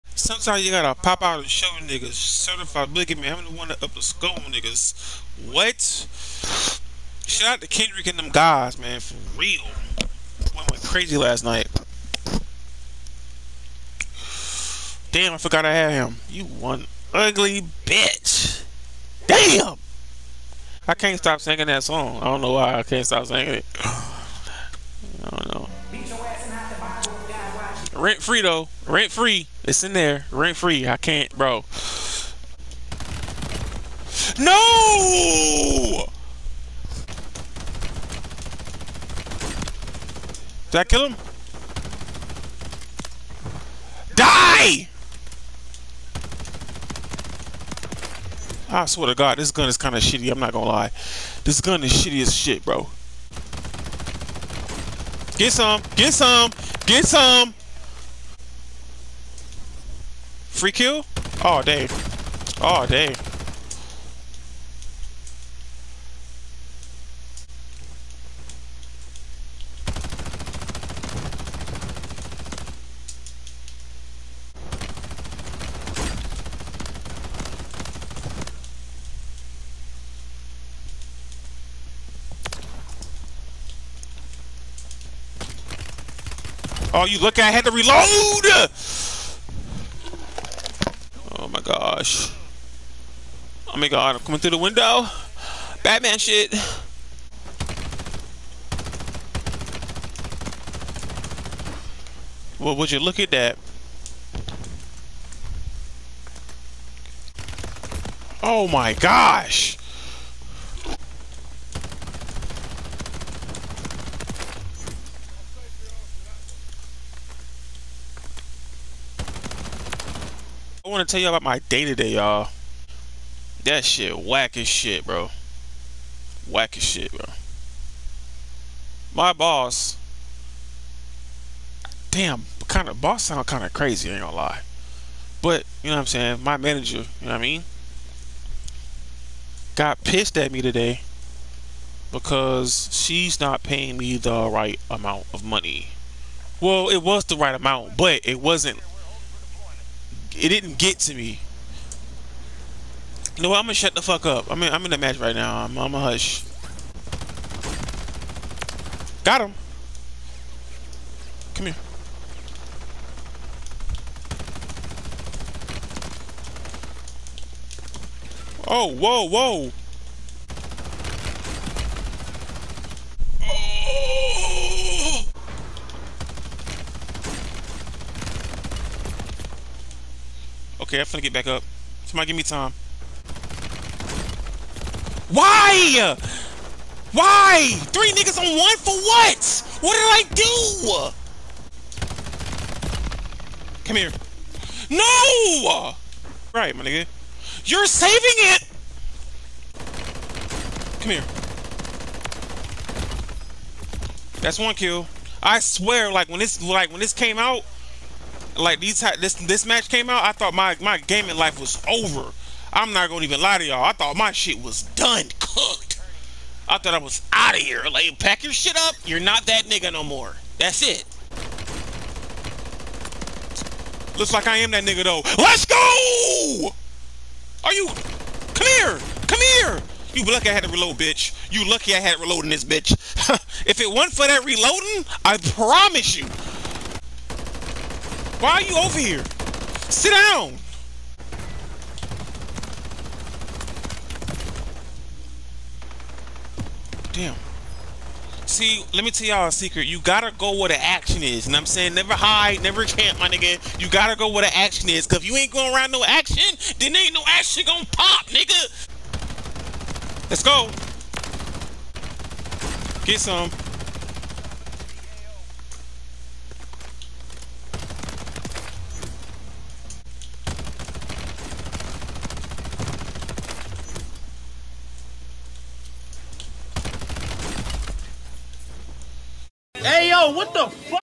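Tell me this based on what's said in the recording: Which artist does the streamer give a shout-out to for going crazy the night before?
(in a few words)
Kendrick.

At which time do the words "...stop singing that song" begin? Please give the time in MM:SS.
00:21.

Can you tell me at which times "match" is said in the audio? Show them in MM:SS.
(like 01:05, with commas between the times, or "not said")
02:34, 03:29.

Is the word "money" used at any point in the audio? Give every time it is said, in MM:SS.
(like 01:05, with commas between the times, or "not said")
02:25.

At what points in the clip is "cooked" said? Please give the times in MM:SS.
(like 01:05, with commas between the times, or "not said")
03:35.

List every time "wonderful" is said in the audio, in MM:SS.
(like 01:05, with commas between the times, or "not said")
not said.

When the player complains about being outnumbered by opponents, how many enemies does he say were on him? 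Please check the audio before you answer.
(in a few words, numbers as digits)
3.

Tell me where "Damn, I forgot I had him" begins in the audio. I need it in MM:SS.
00:15.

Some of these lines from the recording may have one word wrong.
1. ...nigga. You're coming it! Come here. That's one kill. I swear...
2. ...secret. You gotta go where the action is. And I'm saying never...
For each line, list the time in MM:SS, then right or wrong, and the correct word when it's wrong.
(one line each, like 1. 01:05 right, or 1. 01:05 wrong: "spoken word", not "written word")
1. 03:16 wrong: "saving", not "coming"
2. 04:09 right.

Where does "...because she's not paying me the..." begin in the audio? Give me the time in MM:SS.
02:22.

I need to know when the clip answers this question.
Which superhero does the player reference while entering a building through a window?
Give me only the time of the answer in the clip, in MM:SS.
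01:35.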